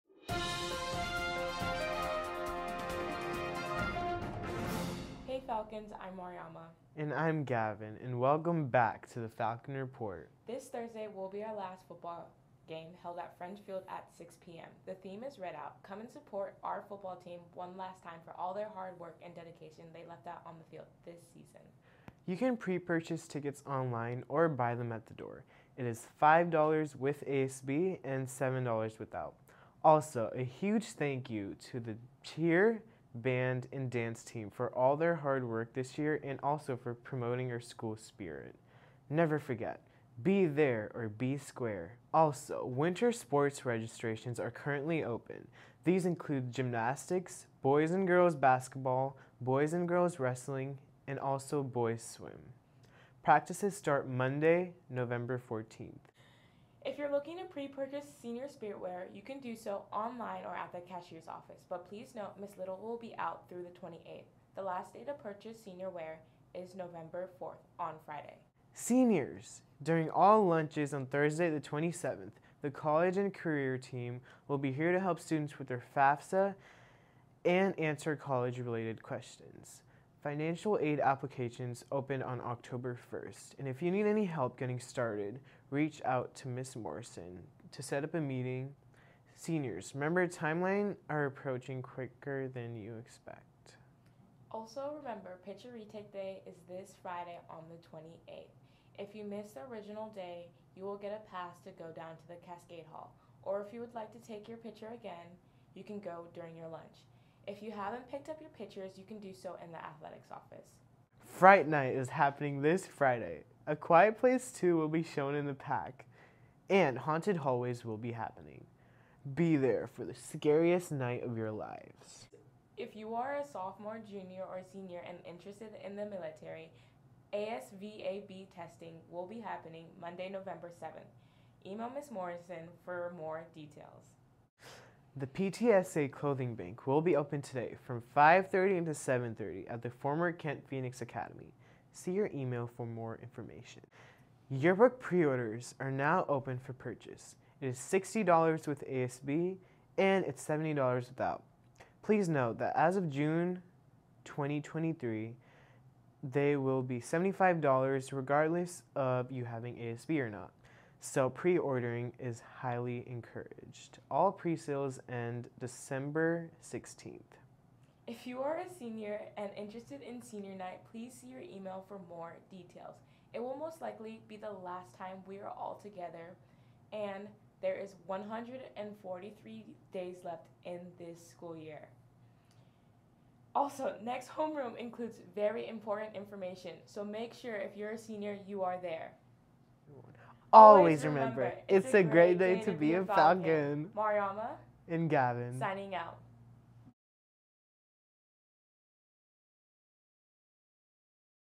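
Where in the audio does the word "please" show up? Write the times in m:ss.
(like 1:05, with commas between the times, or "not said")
1:01, 2:32, 2:50.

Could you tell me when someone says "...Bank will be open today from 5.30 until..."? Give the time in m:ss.
2:16.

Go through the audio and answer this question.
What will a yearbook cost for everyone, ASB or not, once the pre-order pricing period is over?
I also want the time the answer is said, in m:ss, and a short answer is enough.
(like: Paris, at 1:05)
$75, at 2:37.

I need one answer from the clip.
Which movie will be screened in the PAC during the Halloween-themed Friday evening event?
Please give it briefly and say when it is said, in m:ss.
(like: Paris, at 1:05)
A Quiet Place 2, at 1:53.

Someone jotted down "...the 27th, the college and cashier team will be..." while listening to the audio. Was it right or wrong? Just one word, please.
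wrong.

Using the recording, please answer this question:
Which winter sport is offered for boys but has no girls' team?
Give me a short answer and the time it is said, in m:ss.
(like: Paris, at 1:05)
Swim, at 0:51.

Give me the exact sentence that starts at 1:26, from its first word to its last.
Morrison to set up a meeting.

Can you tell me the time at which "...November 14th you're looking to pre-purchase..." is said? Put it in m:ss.
0:54.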